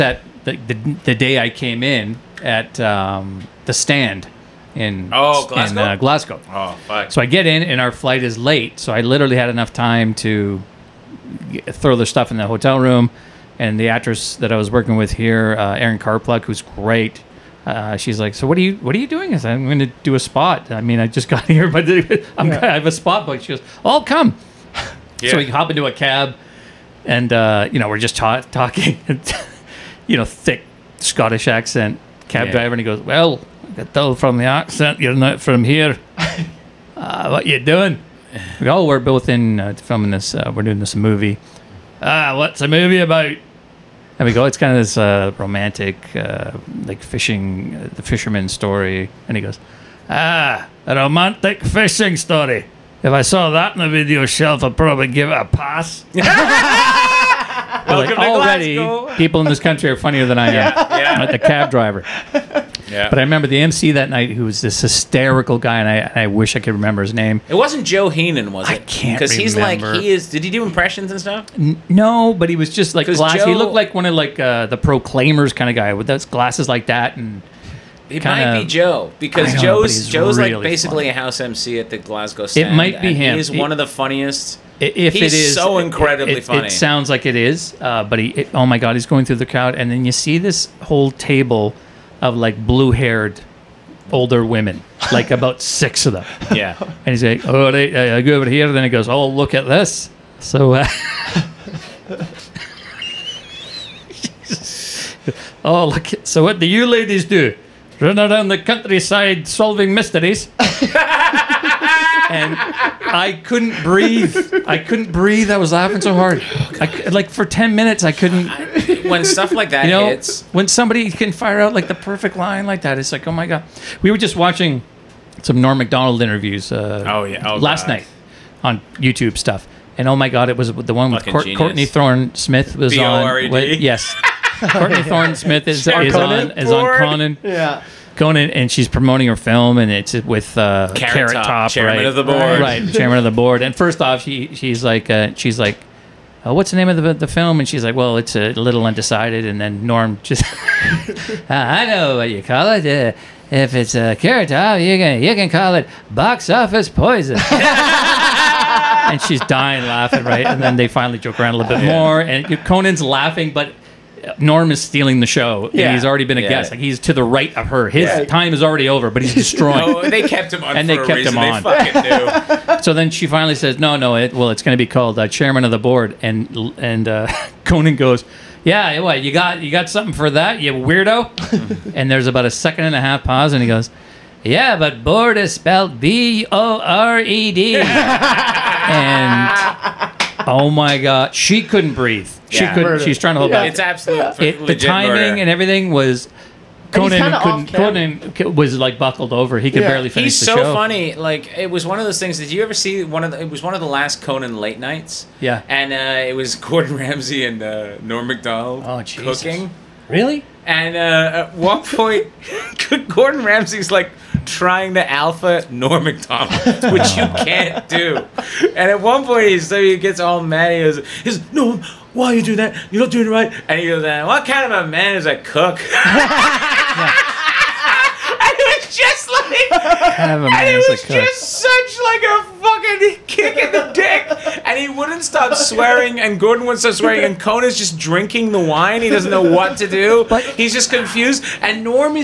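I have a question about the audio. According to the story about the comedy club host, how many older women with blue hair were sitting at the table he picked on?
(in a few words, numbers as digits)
6.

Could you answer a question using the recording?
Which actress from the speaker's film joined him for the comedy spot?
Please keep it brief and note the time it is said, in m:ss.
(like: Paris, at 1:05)
Erin Karpluk, at 0:15.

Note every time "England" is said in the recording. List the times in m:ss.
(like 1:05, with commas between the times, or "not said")
not said.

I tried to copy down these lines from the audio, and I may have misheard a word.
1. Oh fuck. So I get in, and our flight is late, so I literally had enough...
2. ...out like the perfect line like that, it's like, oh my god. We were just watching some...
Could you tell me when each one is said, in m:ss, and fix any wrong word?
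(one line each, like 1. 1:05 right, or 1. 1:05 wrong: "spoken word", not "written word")
1. 0:06 right
2. 2:01 right.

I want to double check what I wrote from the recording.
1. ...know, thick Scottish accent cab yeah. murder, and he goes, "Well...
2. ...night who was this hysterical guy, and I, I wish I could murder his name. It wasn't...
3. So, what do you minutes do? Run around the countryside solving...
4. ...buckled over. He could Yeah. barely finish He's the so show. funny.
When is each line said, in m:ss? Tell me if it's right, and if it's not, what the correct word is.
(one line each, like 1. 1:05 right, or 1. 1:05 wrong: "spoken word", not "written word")
1. 0:30 wrong: "driver", not "murder"
2. 1:04 wrong: "remember", not "murder"
3. 1:46 wrong: "ladies", not "minutes"
4. 3:18 right.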